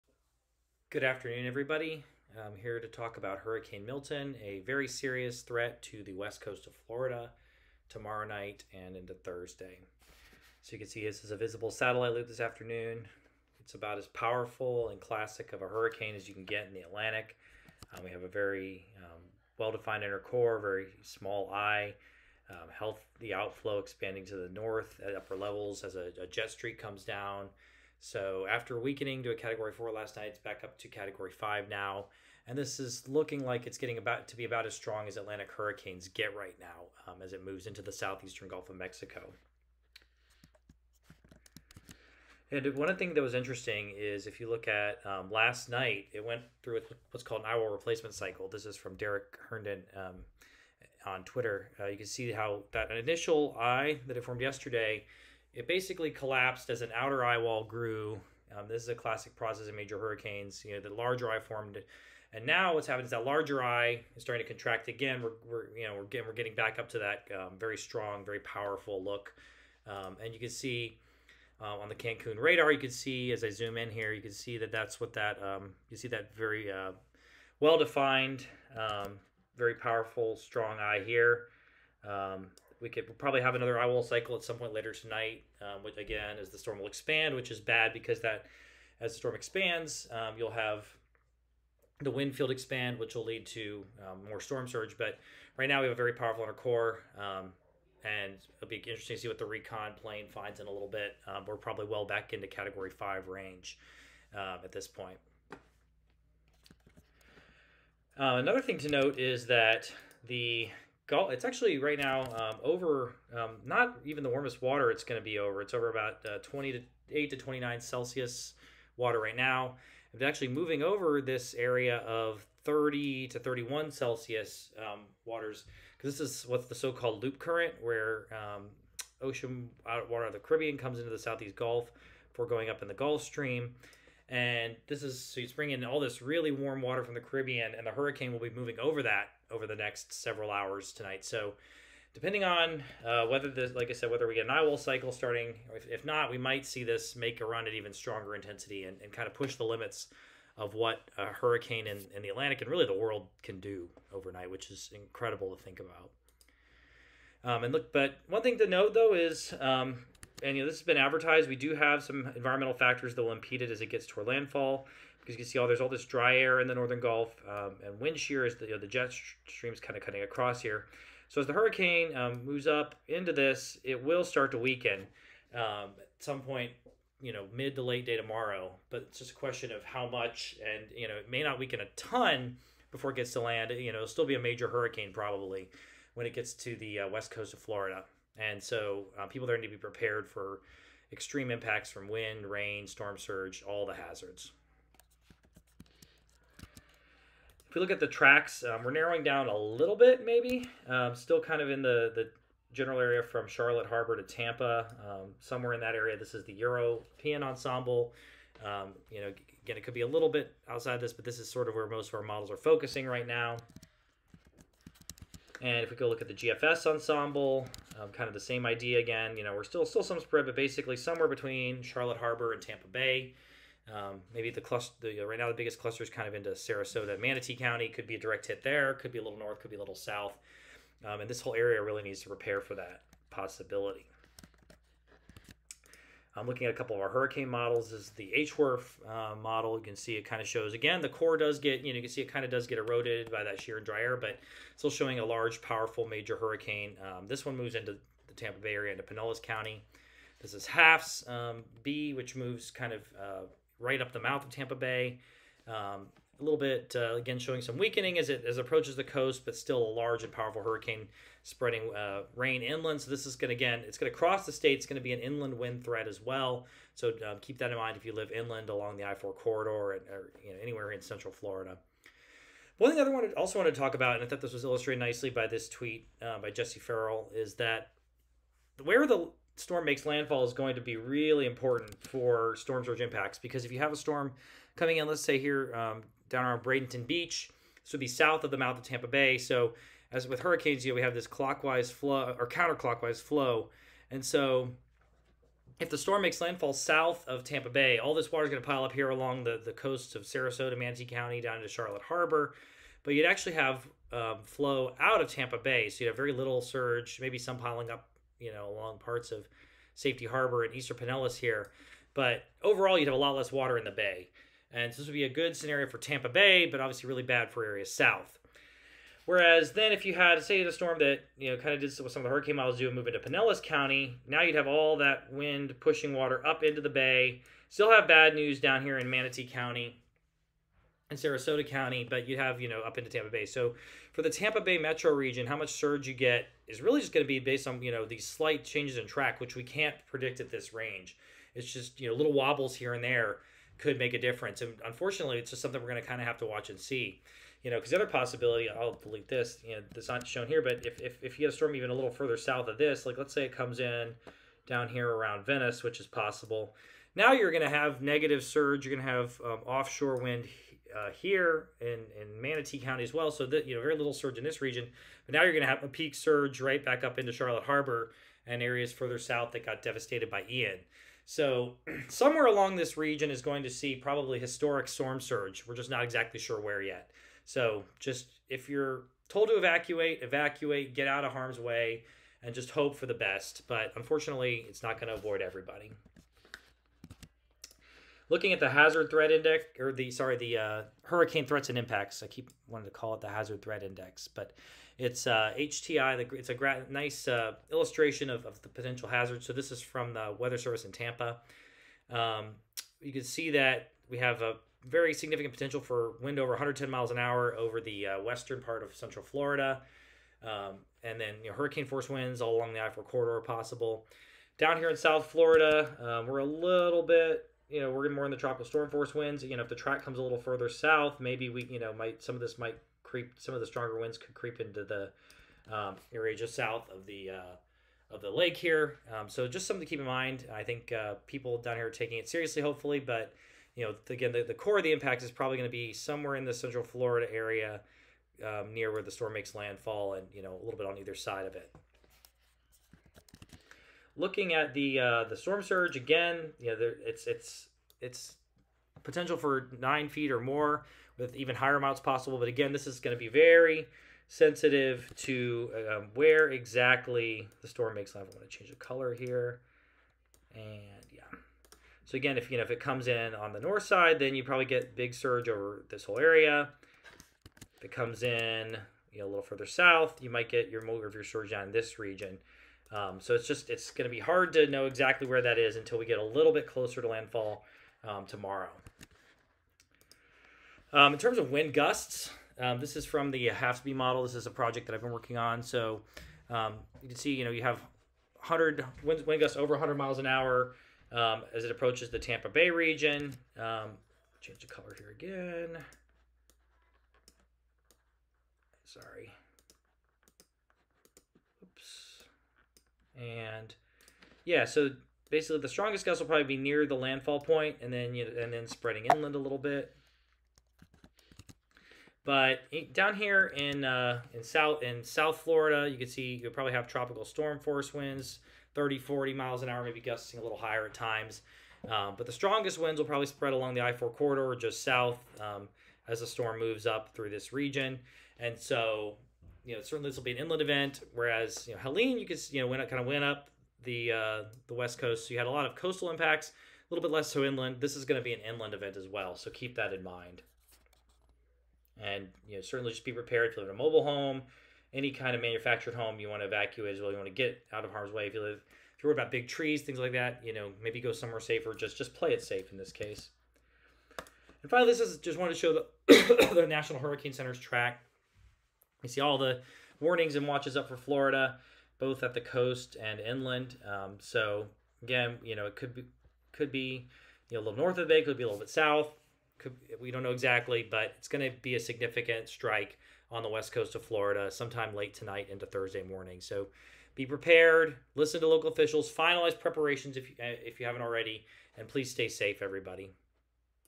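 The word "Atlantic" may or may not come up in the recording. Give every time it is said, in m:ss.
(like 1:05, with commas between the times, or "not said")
0:16, 0:35, 2:32.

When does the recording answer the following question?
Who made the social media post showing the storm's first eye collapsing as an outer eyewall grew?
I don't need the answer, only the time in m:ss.
0:48.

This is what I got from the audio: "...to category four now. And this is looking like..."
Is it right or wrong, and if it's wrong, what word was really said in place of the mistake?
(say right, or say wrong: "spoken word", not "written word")
wrong: "five", not "four".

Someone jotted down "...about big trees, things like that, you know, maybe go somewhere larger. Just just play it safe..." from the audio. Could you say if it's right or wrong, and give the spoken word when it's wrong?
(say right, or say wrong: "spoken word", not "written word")
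wrong: "safer", not "larger".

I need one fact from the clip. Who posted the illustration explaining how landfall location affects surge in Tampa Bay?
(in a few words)
Jesse Ferrell.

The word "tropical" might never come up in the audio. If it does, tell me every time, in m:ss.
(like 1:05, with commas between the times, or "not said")
6:58, 8:36.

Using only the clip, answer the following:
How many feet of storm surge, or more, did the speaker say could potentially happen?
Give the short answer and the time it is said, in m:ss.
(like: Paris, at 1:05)
9 feet, at 7:29.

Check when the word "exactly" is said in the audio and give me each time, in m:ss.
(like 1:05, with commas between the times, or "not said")
6:16, 7:36, 7:54, 9:30.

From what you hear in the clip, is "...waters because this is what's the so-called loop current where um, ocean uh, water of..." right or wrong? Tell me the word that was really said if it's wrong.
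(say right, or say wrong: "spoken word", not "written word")
right.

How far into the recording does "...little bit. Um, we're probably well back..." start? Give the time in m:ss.
1:40.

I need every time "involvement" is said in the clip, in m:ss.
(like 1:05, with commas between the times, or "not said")
not said.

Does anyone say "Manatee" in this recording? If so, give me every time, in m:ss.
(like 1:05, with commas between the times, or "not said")
3:47, 5:00, 5:29, 6:02.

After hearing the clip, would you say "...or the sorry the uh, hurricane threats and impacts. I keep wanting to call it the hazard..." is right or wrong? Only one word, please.
right.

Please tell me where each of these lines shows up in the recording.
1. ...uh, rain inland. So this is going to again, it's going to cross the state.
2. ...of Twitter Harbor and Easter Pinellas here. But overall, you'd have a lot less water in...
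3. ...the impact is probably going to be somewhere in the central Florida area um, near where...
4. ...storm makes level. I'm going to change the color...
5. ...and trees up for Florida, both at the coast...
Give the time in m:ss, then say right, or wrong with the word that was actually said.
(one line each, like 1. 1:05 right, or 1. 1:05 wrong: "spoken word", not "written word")
1. 4:21 right
2. 5:09 wrong: "Safety", not "Twitter"
3. 7:14 right
4. 7:37 right
5. 9:20 wrong: "watches", not "trees".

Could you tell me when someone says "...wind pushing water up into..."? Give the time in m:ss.
5:25.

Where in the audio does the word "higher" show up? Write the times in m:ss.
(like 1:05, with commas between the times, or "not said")
7:31, 8:40.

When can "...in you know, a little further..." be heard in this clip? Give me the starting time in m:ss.
7:48.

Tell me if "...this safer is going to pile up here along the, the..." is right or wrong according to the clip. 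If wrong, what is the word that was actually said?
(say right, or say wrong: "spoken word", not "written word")
wrong: "water", not "safer".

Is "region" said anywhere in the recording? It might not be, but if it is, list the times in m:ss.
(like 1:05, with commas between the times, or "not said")
5:35, 6:04, 6:12, 7:51, 8:12, 8:47.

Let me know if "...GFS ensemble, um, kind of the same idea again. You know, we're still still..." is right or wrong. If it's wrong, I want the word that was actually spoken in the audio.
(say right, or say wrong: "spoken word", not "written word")
right.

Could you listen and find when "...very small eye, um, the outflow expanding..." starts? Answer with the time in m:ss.
0:20.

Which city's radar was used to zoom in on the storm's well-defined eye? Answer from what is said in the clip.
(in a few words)
Cancun.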